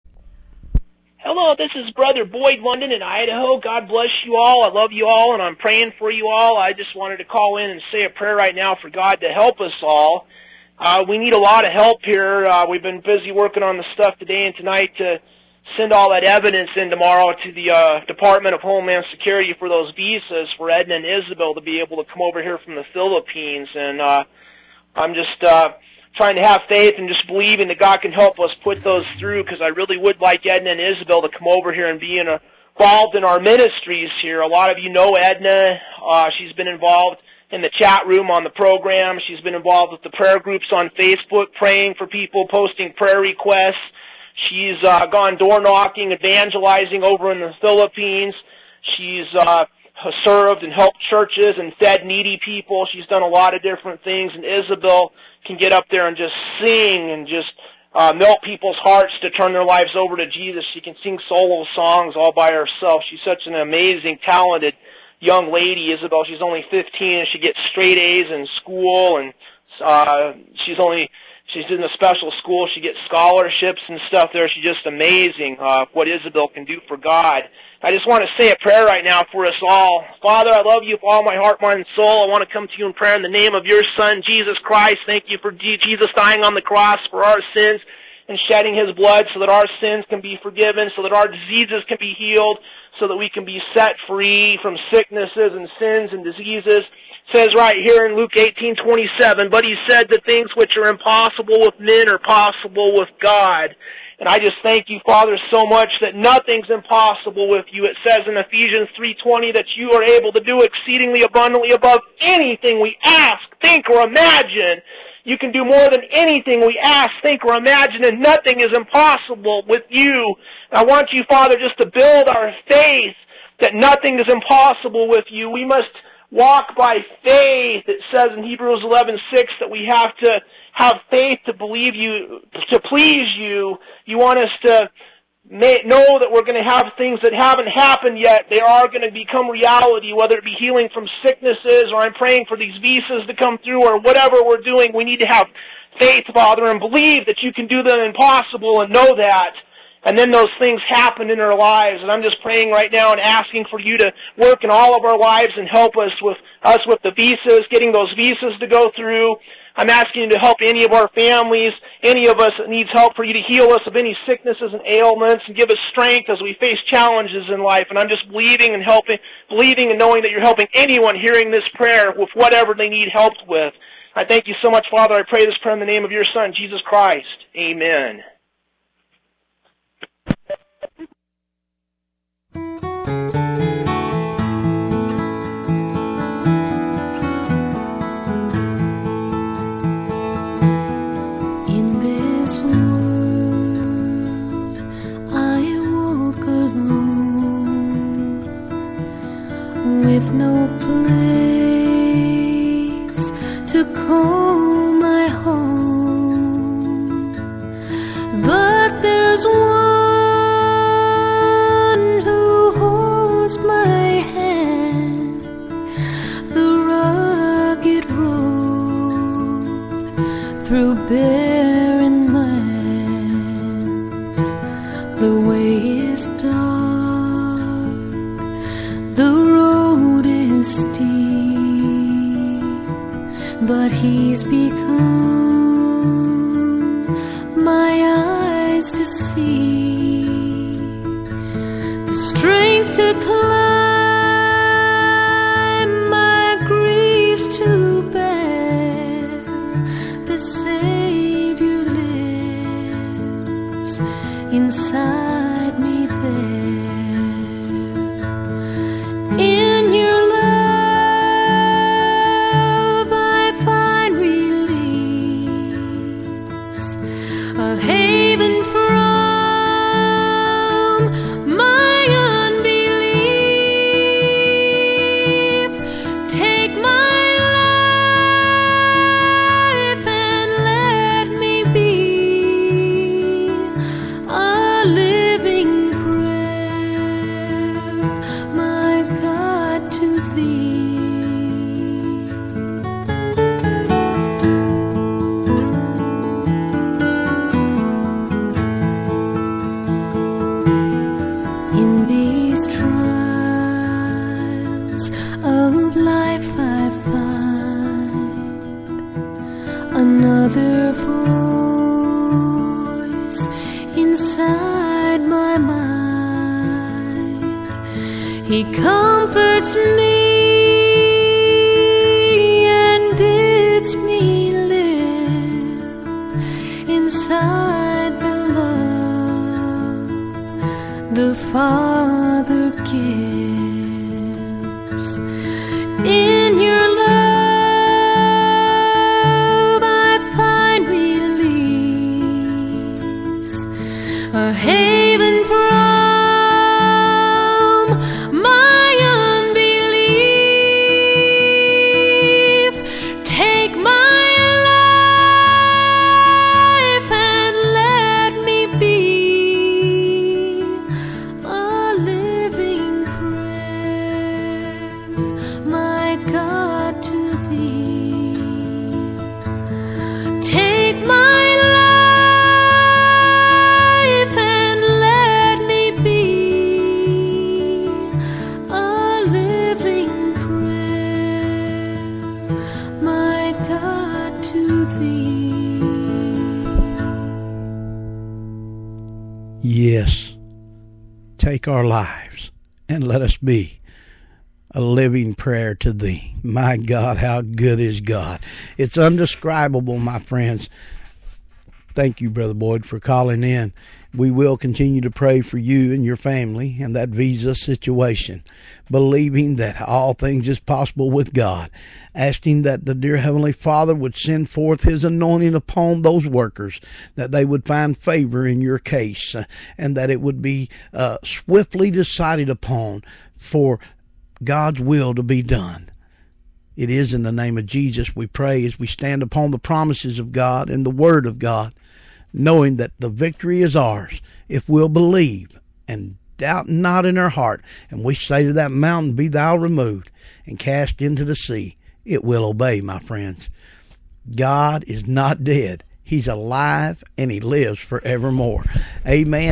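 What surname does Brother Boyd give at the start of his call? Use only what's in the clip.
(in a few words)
London.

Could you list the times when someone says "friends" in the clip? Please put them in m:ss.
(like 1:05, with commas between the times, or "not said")
6:40, 7:22.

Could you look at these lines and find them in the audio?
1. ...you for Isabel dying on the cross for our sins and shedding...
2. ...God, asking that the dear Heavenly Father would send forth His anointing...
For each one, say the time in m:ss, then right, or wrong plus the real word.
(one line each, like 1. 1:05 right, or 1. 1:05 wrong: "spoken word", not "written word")
1. 1:25 wrong: "Jesus", not "Isabel"
2. 6:51 right.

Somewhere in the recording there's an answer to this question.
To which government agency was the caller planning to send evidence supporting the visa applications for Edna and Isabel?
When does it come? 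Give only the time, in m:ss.
0:18.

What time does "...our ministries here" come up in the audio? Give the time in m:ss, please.
0:33.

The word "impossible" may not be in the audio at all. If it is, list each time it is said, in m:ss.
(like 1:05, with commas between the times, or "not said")
1:40, 1:46, 1:58, 2:04, 2:28.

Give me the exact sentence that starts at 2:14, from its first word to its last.
You want us to may, know that we're going to have things that haven't happened yet.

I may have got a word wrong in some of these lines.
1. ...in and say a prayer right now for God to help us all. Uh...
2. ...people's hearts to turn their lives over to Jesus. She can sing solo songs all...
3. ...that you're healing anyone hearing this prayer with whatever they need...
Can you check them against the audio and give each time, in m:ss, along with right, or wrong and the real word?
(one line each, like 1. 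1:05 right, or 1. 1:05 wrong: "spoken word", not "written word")
1. 0:07 right
2. 0:58 right
3. 2:50 wrong: "helping", not "healing".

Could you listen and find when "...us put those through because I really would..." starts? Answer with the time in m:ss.
0:28.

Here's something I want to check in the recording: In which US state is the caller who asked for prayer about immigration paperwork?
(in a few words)
Idaho.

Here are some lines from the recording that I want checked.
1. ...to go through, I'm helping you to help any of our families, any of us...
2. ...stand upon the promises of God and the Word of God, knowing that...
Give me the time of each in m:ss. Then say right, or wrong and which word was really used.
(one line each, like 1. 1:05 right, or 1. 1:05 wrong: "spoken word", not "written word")
1. 2:38 wrong: "asking", not "helping"
2. 7:08 right.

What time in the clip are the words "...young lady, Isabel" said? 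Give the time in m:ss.
1:05.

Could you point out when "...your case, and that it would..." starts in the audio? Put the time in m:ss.
6:58.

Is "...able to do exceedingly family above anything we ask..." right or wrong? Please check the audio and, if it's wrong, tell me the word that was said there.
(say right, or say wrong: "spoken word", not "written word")
wrong: "abundantly", not "family".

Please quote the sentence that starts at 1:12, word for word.
She gets scholarships and stuff there.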